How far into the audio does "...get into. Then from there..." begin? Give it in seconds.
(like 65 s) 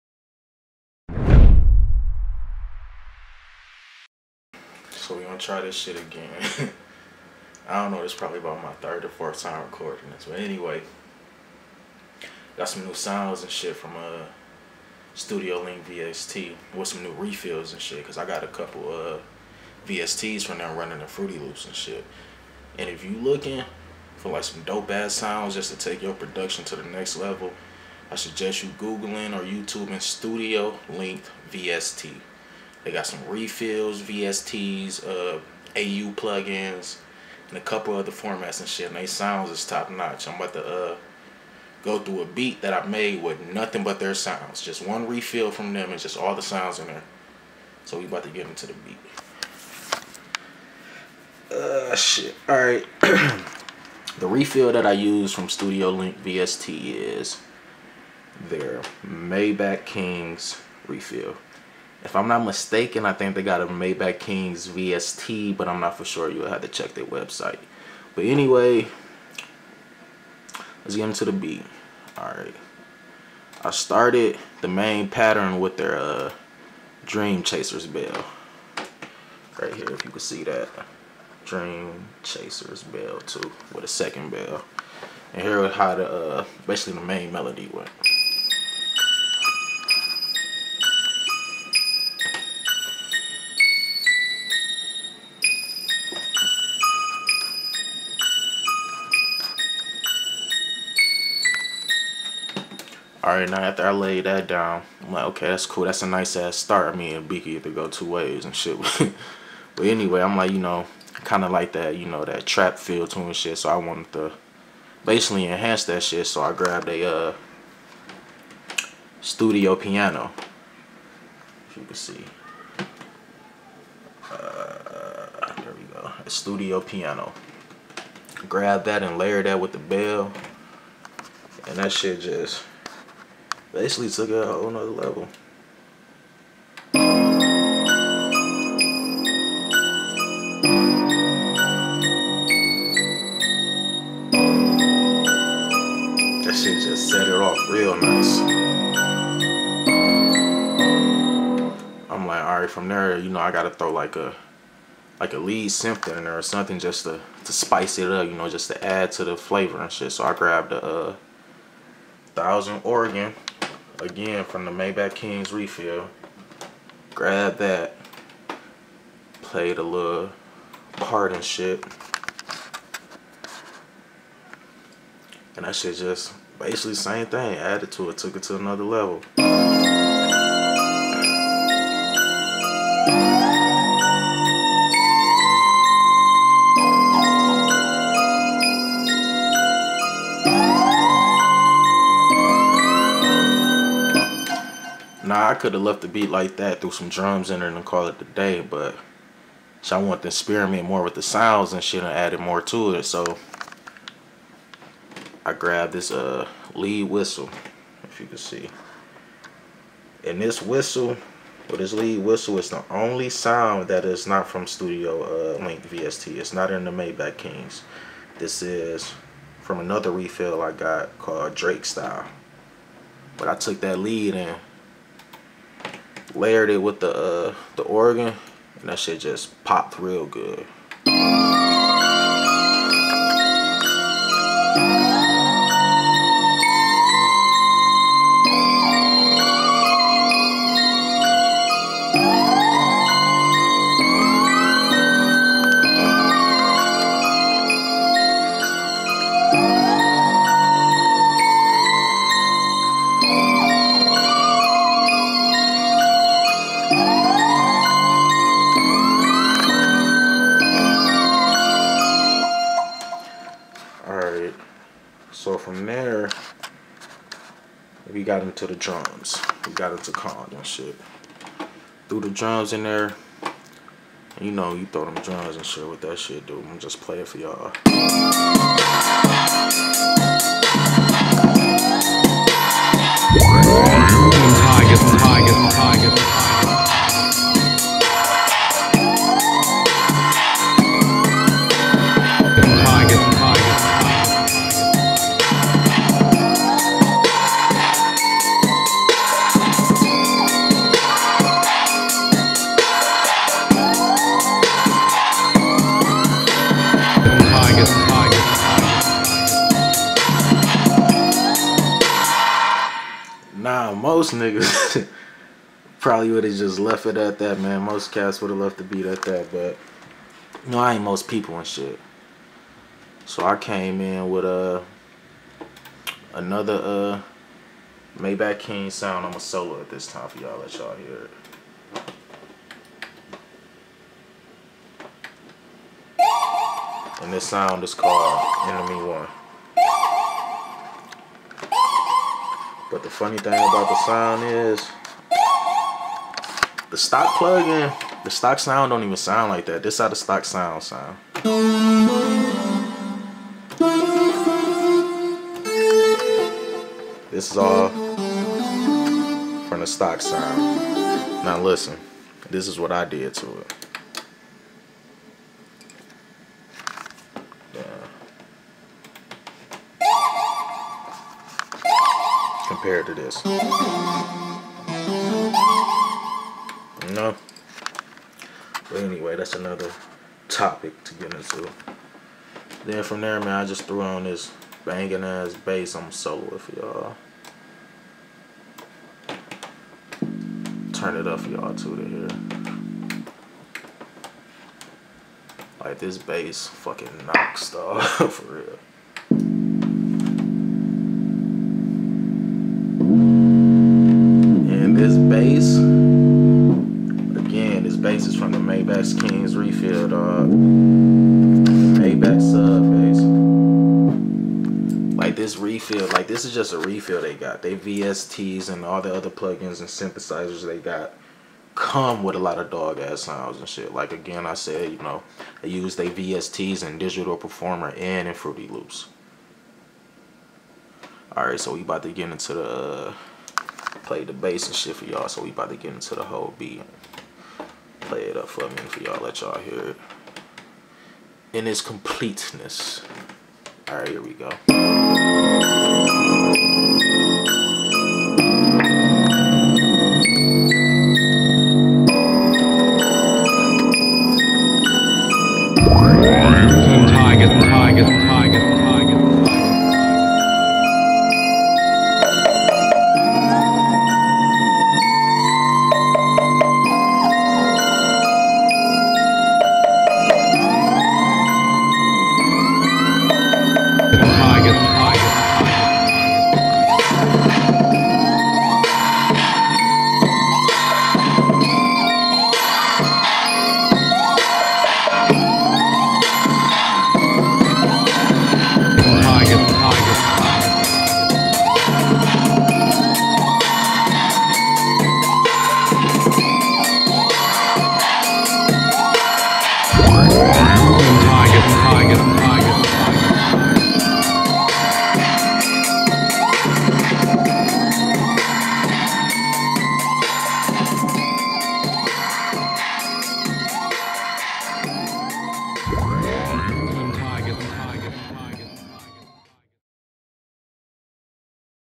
381 s.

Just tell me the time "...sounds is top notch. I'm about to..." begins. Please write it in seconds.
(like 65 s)
39 s.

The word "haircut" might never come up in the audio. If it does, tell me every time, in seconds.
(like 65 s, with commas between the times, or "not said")
not said.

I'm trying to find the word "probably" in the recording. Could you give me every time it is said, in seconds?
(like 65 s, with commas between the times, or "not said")
8 s, 315 s.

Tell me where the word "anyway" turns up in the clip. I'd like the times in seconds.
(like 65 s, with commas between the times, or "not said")
10 s, 68 s, 109 s, 378 s.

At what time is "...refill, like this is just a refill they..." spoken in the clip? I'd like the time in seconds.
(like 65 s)
415 s.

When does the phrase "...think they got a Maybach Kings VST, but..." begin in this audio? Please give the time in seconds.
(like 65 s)
63 s.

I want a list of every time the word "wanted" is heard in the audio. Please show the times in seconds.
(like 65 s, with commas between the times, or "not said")
113 s, 200 s.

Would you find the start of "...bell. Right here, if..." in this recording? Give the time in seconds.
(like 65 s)
77 s.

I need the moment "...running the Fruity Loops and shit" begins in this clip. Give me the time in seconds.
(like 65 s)
20 s.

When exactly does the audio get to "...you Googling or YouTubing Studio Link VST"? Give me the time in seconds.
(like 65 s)
28 s.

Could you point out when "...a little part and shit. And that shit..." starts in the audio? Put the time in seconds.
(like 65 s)
169 s.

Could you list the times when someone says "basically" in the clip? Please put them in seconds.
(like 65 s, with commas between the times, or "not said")
86 s, 115 s, 133 s, 176 s.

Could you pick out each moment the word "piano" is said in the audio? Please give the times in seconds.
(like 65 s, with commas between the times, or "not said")
119 s, 126 s.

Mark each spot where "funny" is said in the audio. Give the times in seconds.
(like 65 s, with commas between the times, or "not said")
343 s.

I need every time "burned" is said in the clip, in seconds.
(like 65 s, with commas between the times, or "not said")
not said.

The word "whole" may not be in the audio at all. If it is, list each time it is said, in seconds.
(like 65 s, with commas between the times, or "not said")
134 s, 436 s.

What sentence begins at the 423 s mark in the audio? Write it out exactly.
Like again, I said, you know, they use their VSTs and Digital Performer and in Fruity Loops.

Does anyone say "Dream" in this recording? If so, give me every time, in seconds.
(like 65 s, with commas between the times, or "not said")
77 s, 81 s.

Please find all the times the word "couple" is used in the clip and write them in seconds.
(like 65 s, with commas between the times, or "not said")
18 s, 37 s.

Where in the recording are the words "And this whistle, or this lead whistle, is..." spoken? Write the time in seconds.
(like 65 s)
210 s.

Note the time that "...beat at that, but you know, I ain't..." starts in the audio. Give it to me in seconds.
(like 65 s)
318 s.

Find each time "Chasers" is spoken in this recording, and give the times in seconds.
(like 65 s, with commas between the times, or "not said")
77 s, 82 s.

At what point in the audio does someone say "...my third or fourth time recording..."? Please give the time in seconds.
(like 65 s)
8 s.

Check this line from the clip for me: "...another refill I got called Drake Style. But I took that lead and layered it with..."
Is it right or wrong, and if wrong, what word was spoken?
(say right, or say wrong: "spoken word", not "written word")
right.